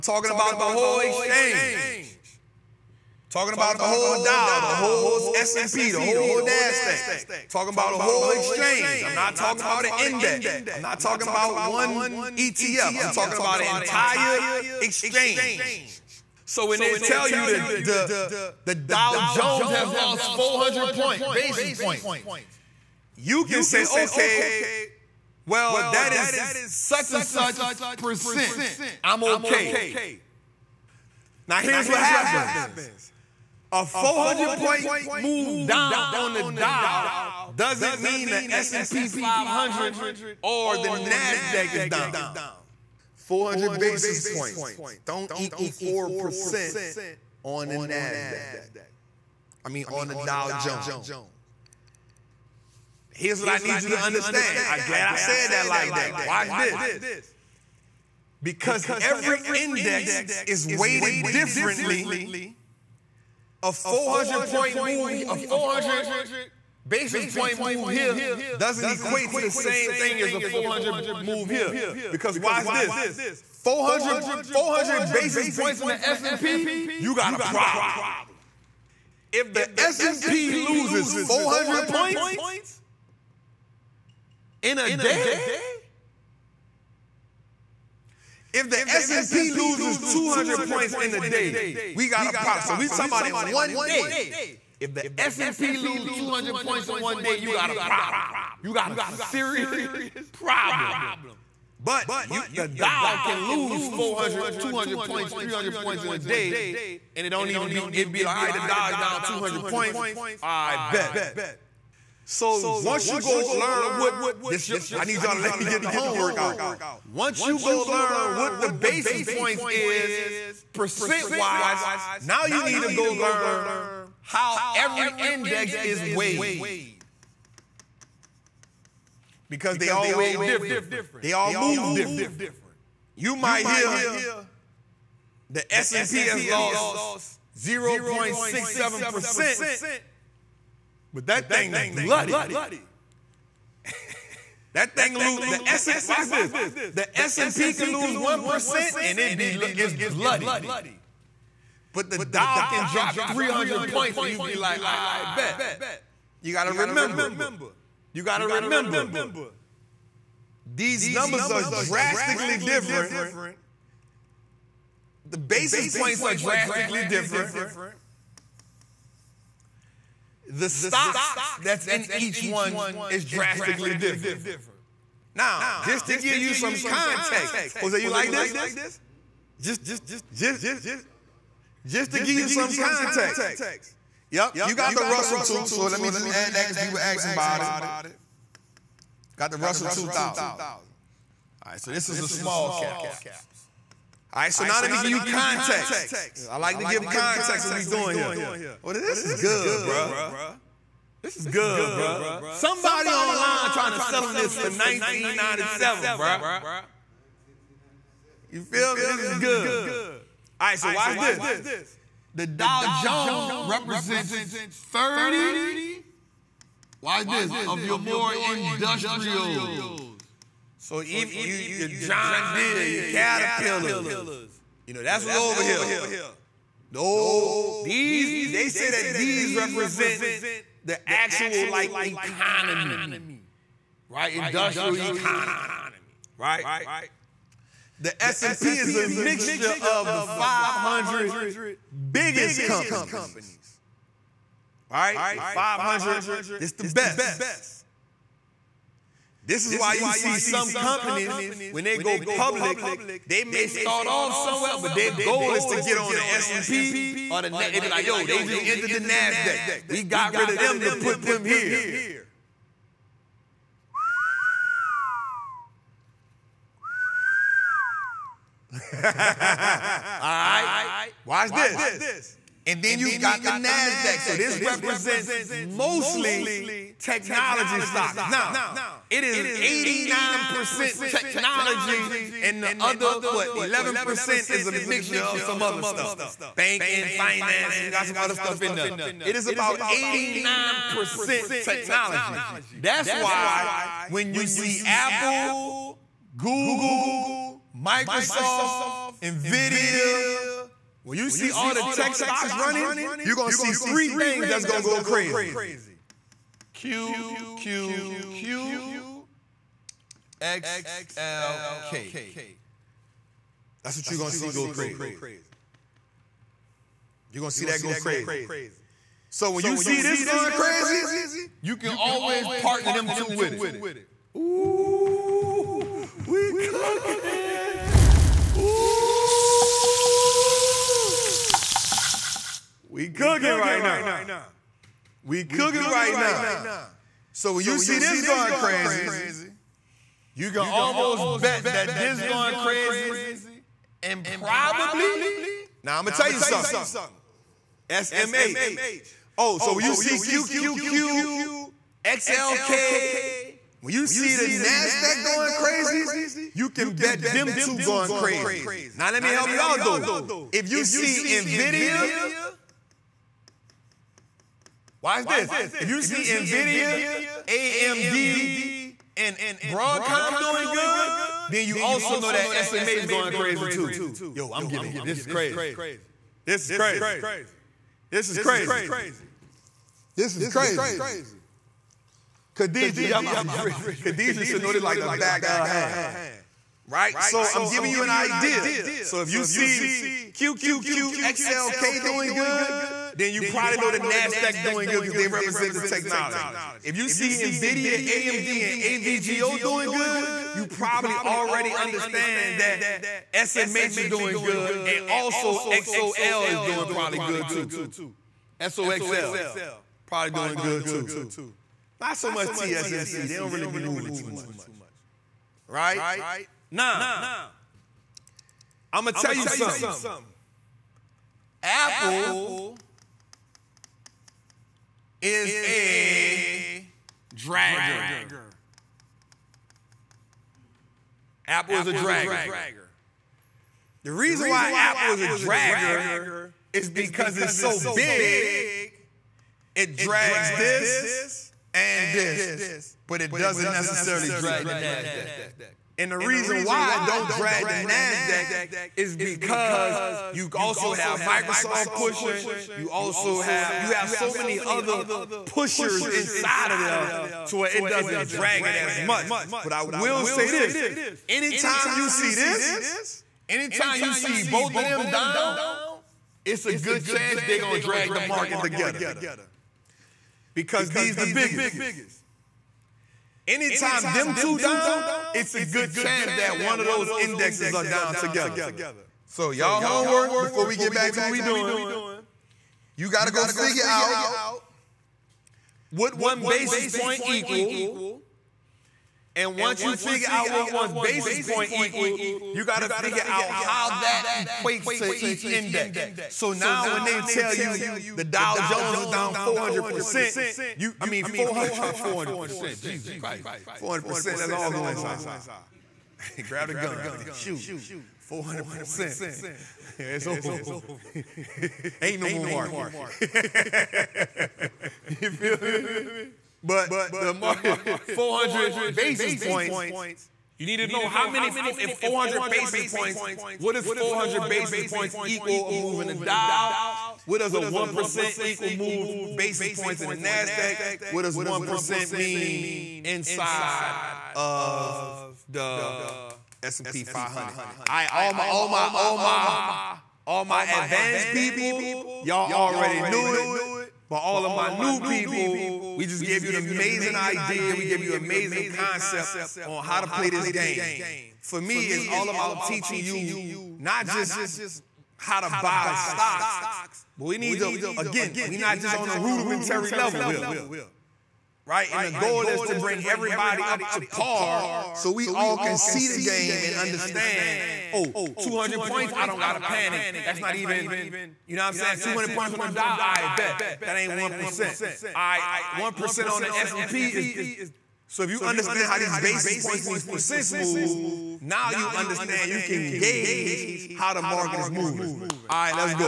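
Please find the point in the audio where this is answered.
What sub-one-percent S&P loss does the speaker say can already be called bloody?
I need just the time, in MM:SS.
02:17.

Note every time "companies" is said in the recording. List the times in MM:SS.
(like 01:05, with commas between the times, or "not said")
04:02, 04:10.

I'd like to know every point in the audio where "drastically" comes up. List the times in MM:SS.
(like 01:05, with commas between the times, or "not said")
02:41, 02:46, 02:53.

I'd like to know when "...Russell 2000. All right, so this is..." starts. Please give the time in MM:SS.
03:09.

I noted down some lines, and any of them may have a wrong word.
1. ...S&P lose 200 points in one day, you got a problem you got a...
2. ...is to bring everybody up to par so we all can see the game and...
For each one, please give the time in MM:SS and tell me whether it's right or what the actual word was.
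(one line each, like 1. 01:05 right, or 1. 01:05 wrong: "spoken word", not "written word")
1. 01:35 right
2. 09:22 right.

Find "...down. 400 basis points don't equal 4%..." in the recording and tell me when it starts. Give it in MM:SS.
00:41.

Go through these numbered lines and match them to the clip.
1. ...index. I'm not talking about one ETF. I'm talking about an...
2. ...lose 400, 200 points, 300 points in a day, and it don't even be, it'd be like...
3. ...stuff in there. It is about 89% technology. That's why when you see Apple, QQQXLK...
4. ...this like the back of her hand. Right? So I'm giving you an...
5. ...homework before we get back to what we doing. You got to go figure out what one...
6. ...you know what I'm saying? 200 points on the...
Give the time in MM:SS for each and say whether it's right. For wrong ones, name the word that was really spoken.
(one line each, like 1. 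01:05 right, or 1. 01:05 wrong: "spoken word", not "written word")
1. 00:09 right
2. 01:43 right
3. 04:48 wrong: "Google", not "QQQXLK"
4. 06:24 right
5. 07:59 right
6. 09:31 right.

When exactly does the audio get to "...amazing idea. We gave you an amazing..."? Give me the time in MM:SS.
09:06.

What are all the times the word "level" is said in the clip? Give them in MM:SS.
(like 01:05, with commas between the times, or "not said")
09:19.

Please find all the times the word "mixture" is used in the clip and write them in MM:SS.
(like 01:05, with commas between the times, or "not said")
03:59, 04:44.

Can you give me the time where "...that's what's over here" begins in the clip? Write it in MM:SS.
03:45.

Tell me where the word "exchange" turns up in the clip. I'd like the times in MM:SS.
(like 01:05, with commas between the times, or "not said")
00:01, 00:08, 00:14.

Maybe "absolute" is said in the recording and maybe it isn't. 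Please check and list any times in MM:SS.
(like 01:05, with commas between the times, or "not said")
not said.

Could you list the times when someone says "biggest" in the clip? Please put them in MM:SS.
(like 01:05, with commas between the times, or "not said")
04:02, 07:51.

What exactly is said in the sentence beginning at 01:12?
Because watch this, 400, 400 basis points in the S&P, you got a problem.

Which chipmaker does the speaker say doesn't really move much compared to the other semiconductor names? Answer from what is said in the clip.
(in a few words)
TSMC.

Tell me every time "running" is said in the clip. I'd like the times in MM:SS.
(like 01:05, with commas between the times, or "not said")
05:02.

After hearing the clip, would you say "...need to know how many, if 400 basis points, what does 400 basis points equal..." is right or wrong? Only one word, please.
right.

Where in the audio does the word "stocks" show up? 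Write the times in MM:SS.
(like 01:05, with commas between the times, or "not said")
02:50, 04:37, 05:02, 09:15.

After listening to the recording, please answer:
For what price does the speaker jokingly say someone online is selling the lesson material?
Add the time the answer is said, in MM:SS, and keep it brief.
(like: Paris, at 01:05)
1997, at 03:24.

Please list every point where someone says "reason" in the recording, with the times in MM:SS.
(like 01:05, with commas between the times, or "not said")
07:14, 07:26.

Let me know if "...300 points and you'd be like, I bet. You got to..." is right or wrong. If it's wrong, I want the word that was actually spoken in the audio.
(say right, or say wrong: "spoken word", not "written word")
right.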